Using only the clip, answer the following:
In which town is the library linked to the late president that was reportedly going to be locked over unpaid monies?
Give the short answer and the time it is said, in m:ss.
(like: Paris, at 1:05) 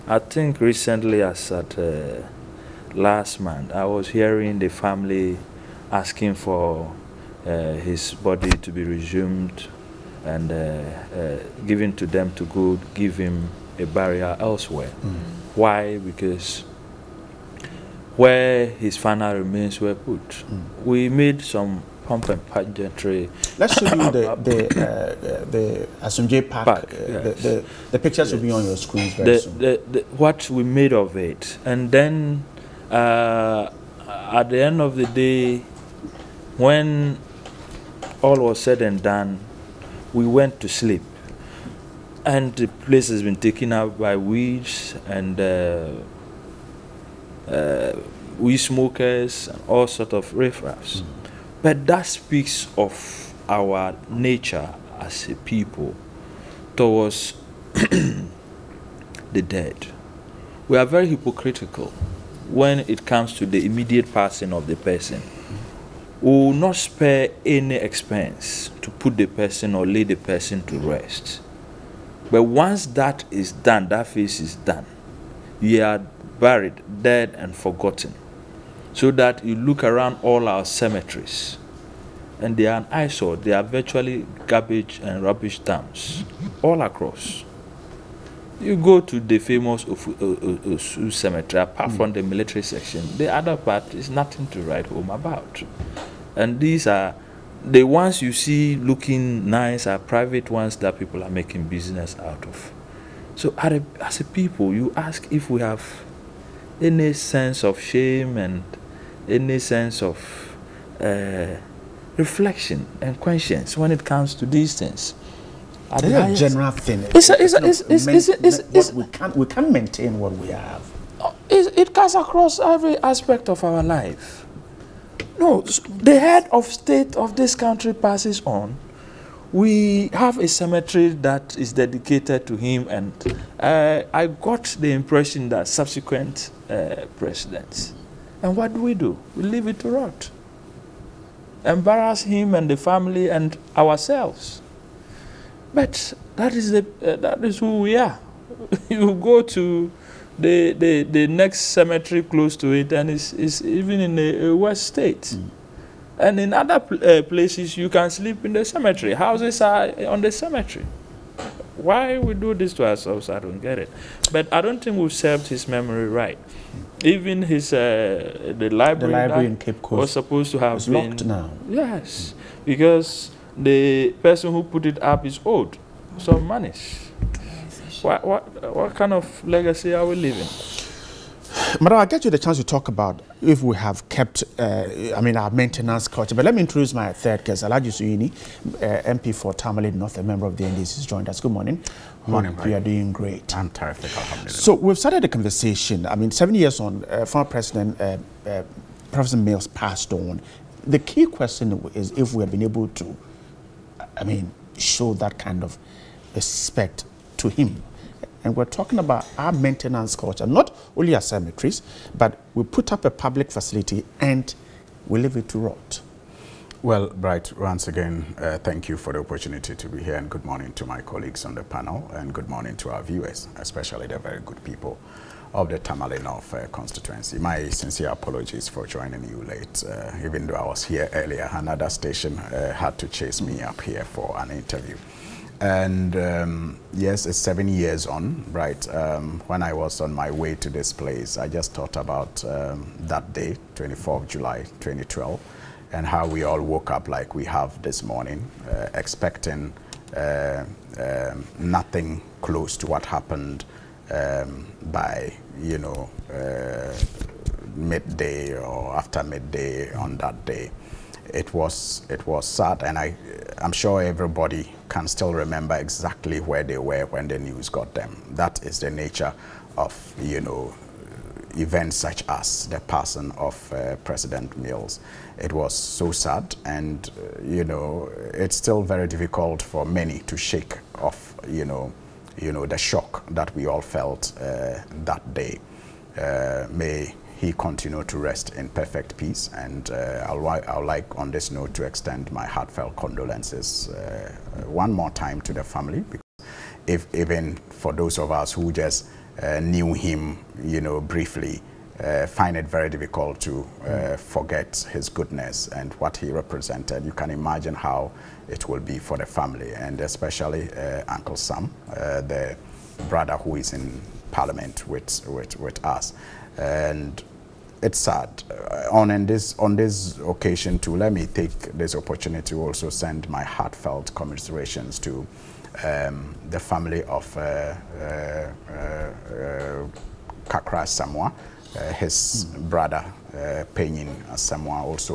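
Cape Coast, at 2:49.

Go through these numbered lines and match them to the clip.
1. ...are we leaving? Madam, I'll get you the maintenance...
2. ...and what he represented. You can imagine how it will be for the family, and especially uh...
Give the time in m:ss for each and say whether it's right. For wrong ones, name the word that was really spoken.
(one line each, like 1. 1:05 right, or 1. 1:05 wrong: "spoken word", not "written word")
1. 2:59 wrong: "chance", not "maintenance"
2. 5:05 right.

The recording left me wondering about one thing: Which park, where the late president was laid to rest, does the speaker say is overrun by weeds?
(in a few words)
Asomdwee Park.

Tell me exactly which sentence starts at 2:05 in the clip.
No, the head of state of this country passes on.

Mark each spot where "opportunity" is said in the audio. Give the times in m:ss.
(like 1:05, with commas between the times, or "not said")
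3:39, 5:21.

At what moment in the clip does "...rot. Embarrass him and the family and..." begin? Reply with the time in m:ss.
2:19.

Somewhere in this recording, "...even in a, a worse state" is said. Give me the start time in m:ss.
2:33.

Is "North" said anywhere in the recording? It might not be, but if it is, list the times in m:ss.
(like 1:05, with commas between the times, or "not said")
3:09, 3:46.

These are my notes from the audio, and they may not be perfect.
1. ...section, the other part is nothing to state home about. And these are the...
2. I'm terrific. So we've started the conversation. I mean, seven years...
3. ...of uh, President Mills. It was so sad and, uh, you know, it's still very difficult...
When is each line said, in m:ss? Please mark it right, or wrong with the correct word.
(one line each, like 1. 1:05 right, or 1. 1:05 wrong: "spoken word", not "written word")
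1. 1:32 wrong: "write", not "state"
2. 3:13 right
3. 4:33 right.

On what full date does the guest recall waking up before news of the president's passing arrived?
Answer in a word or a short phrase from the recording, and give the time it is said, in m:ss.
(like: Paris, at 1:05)
24 July 2012, at 4:03.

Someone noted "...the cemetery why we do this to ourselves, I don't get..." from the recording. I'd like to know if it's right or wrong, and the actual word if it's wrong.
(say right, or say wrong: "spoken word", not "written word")
right.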